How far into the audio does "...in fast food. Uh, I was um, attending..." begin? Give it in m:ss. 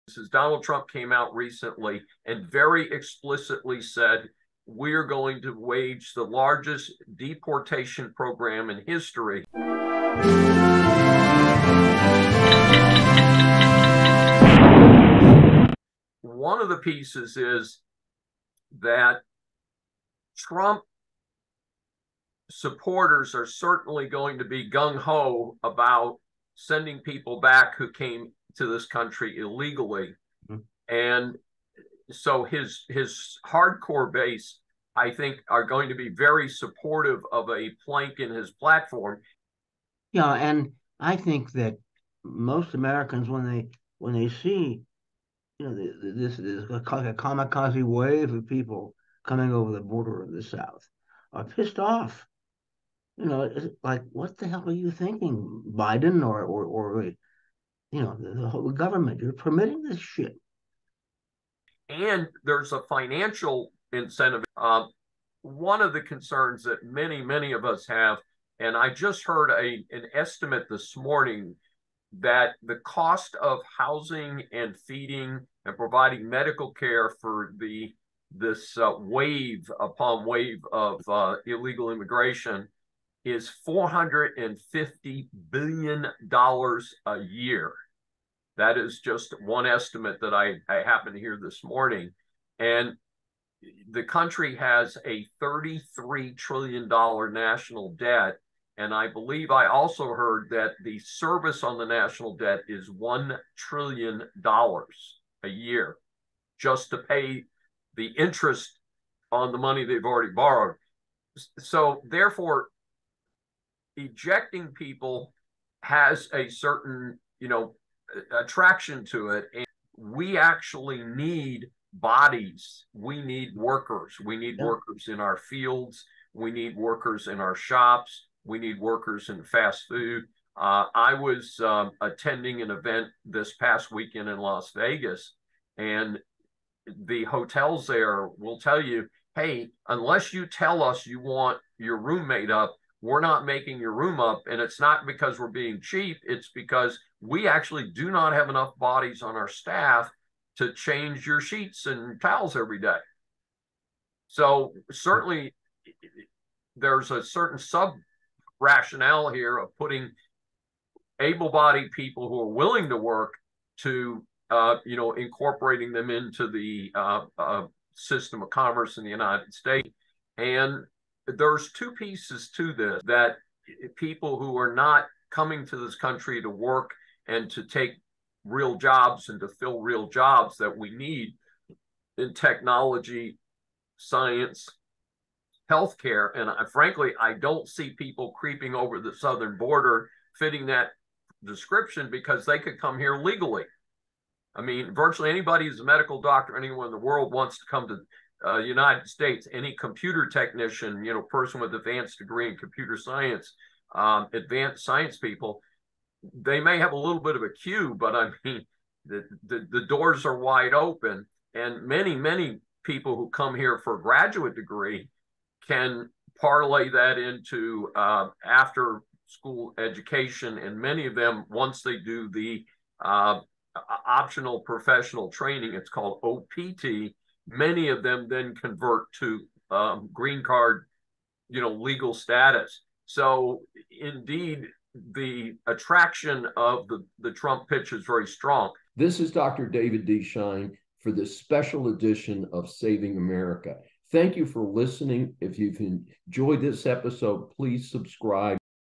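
2:09.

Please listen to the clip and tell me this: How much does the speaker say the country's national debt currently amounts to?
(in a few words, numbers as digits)
$33 trillion.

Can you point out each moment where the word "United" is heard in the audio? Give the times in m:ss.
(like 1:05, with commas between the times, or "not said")
2:49, 3:18.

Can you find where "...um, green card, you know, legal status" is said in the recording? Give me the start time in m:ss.
3:49.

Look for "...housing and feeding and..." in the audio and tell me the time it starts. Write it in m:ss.
1:13.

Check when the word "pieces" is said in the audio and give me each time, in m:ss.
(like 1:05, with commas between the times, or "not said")
0:16, 2:51.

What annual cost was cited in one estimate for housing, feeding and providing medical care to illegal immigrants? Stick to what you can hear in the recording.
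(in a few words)
$450 billion.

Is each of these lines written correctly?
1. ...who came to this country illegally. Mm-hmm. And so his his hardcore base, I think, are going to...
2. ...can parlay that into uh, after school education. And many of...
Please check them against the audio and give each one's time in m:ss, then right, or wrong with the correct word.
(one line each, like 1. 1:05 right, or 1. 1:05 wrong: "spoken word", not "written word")
1. 0:27 right
2. 3:35 right.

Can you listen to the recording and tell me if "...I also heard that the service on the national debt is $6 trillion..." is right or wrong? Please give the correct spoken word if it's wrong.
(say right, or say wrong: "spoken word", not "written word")
wrong: "1", not "6".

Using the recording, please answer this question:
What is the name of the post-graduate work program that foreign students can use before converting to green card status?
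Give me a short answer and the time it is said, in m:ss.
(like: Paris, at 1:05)
Optional Professional Training, at 3:44.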